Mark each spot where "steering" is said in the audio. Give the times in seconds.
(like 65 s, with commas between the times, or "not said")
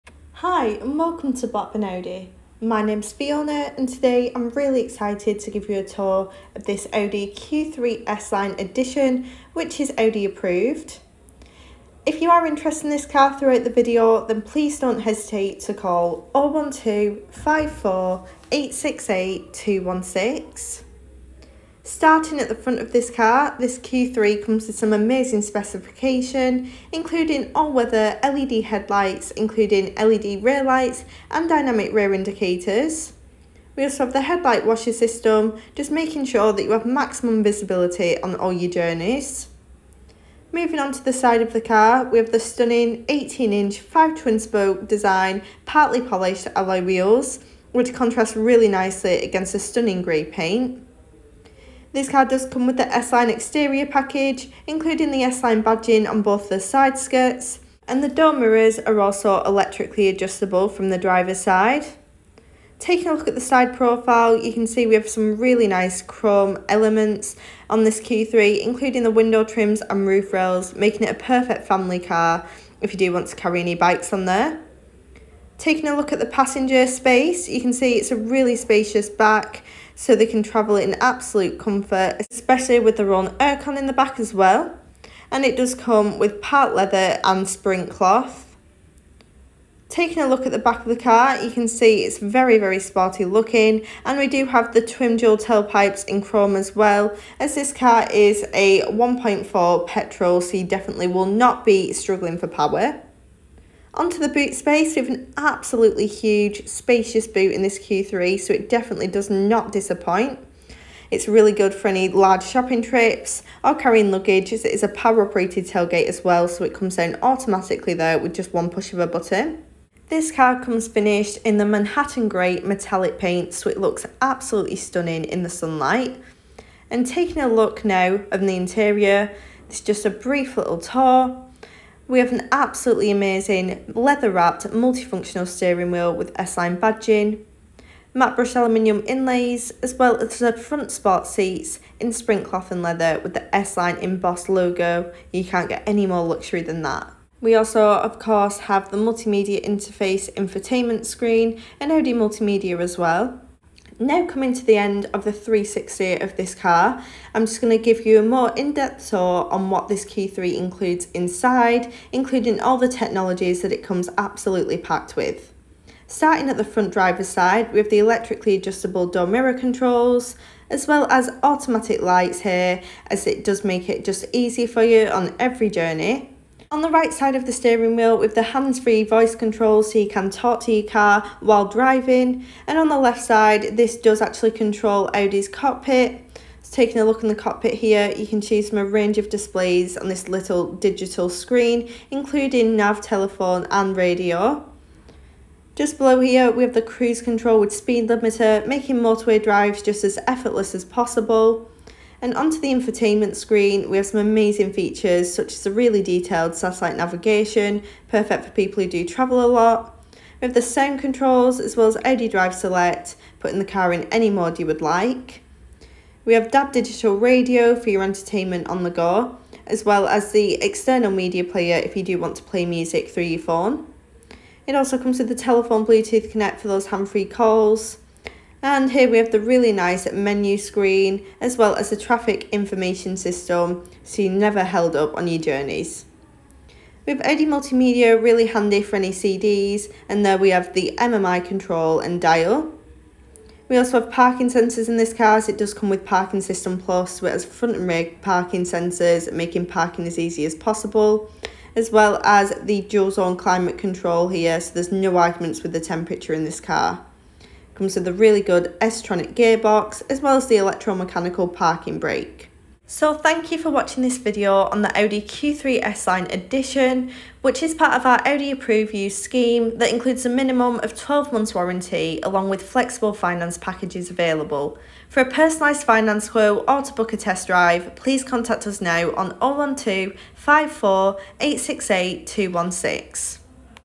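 135 s, 177 s.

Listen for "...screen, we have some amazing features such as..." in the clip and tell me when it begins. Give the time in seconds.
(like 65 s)
203 s.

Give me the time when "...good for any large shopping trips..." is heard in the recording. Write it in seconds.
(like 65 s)
111 s.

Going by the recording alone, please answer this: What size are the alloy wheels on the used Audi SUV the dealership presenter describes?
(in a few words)
18-inch.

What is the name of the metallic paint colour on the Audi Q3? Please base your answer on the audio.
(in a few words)
Manhattan Grey.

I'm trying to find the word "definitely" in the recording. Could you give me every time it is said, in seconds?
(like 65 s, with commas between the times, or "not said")
100 s, 108 s.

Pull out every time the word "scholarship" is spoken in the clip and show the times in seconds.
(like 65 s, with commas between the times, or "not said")
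not said.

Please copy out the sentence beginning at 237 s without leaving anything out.
We have Audi Multimedia, really handy for any CDs, and there we have the MMI control and dial.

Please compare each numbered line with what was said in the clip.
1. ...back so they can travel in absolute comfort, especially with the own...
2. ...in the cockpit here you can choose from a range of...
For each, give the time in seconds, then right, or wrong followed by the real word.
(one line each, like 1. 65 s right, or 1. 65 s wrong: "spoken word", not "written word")
1. 79 s right
2. 187 s right.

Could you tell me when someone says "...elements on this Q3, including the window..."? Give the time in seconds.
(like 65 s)
66 s.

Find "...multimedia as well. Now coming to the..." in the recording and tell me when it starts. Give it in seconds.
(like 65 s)
152 s.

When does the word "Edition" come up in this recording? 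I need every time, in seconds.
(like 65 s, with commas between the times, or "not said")
8 s, 266 s.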